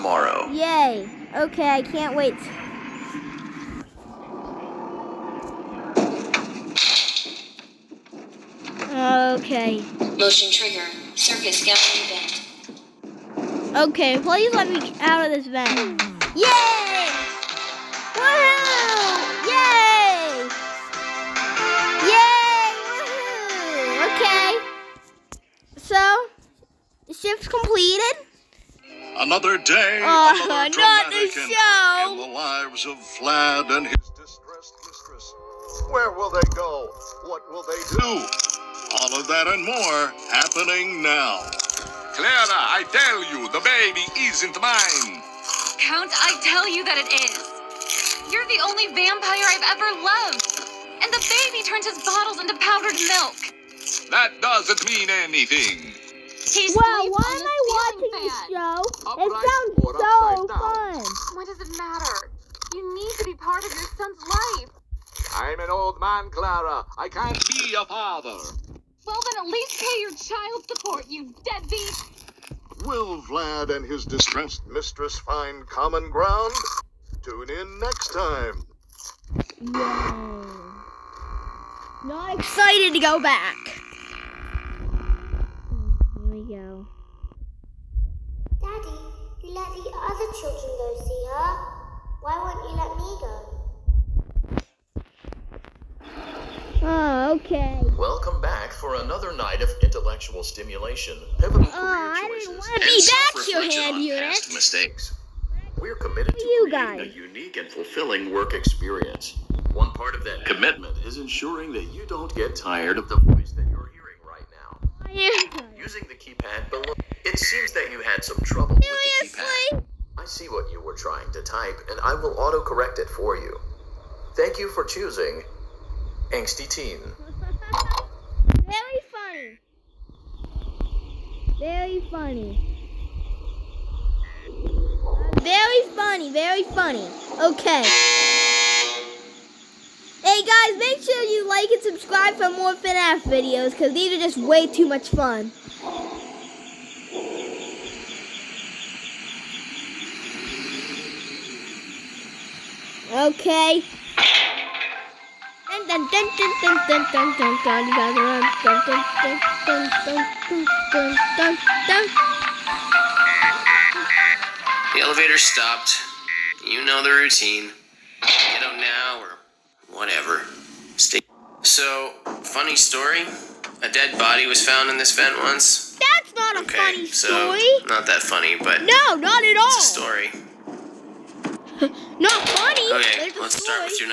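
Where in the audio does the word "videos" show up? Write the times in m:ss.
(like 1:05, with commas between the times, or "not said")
2:23.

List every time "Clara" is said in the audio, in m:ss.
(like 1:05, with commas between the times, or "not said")
0:42, 1:06.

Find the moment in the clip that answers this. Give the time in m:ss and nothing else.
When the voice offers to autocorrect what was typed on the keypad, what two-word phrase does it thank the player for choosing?
2:06.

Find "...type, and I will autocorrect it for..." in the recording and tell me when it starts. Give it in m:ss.
2:01.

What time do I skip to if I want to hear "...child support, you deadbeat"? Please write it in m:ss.
1:10.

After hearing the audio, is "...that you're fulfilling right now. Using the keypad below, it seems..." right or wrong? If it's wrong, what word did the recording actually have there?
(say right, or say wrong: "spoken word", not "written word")
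wrong: "hearing", not "fulfilling".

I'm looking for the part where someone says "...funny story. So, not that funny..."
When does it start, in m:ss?
2:56.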